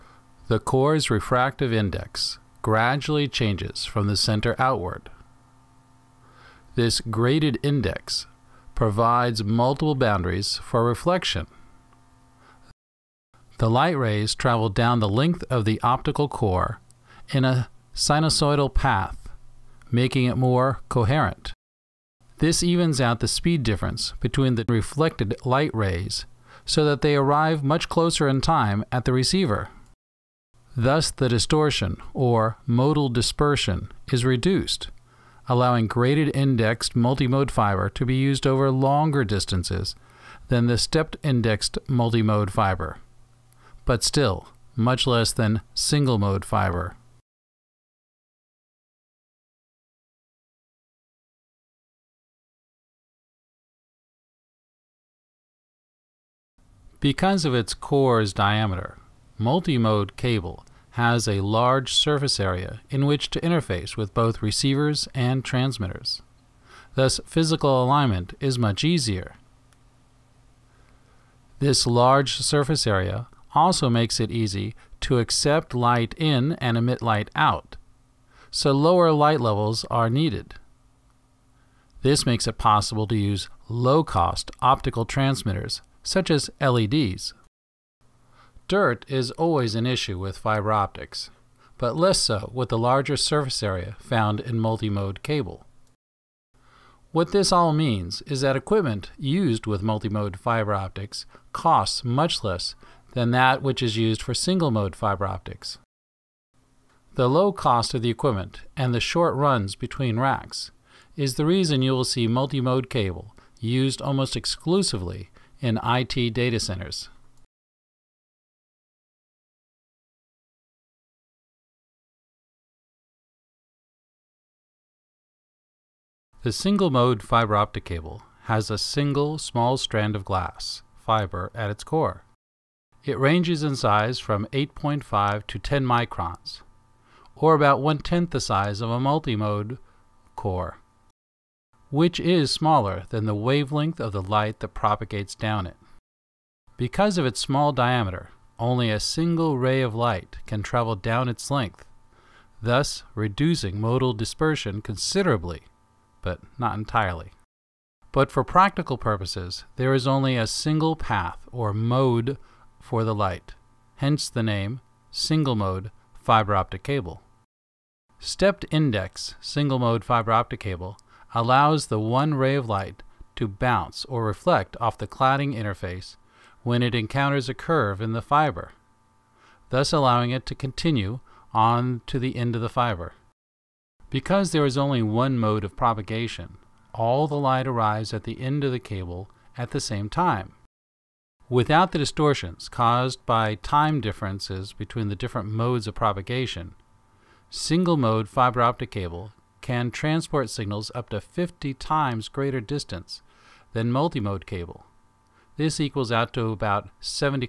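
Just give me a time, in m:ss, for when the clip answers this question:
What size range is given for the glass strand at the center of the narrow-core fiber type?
2:14.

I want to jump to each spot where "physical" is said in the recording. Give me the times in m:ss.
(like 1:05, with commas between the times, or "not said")
1:07.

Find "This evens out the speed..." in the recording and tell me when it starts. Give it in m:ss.
0:22.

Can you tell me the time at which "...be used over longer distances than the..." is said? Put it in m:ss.
0:38.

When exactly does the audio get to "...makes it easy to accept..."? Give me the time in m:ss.
1:13.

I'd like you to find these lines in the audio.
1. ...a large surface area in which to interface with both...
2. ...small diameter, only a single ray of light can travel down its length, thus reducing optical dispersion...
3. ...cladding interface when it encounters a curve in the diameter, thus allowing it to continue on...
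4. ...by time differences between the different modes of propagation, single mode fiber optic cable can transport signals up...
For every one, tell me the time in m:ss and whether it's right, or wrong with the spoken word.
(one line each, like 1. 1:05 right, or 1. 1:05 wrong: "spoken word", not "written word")
1. 1:01 right
2. 2:27 wrong: "modal", not "optical"
3. 2:55 wrong: "fiber", not "diameter"
4. 3:13 right.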